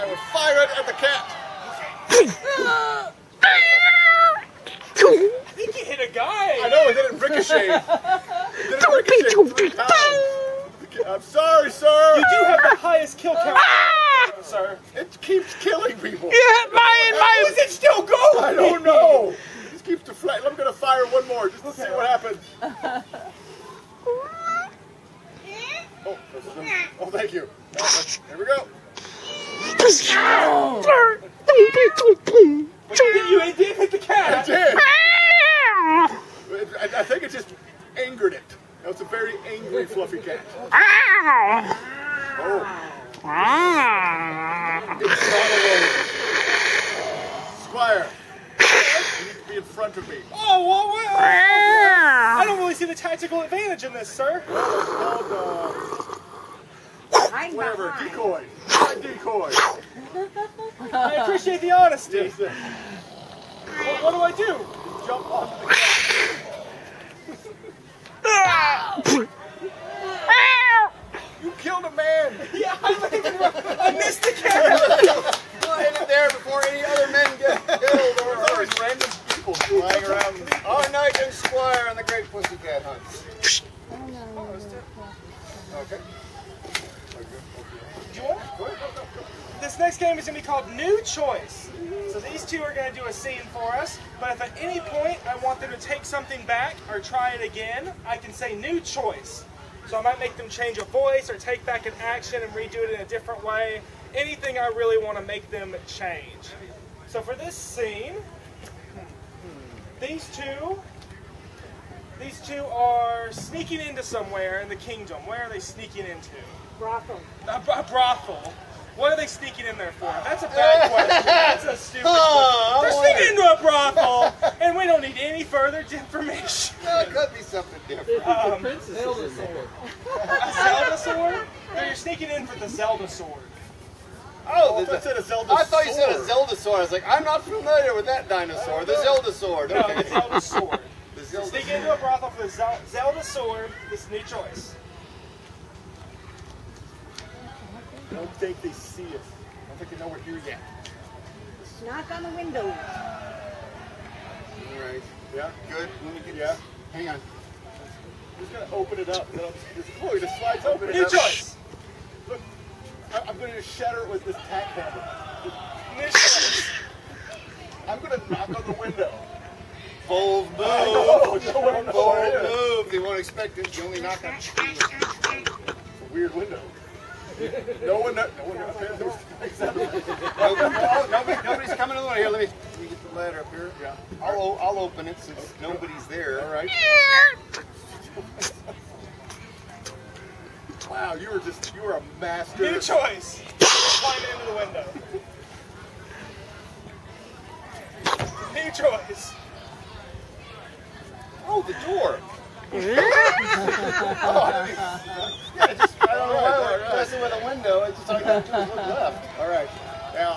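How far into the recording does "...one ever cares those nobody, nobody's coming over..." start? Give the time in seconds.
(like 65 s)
178 s.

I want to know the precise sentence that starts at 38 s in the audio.
That was a very angry, fluffy cat.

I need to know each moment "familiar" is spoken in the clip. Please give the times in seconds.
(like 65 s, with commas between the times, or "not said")
137 s.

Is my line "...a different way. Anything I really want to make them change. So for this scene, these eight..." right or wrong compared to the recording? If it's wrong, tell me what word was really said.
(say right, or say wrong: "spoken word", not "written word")
wrong: "two", not "eight".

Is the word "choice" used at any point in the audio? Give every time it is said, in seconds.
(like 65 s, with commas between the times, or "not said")
91 s, 98 s, 144 s, 161 s, 192 s, 198 s.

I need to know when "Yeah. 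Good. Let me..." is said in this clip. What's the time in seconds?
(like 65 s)
155 s.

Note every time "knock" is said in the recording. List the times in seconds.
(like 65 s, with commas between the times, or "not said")
151 s, 168 s, 174 s.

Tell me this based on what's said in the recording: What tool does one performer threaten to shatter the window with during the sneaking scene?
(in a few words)
tack hammer.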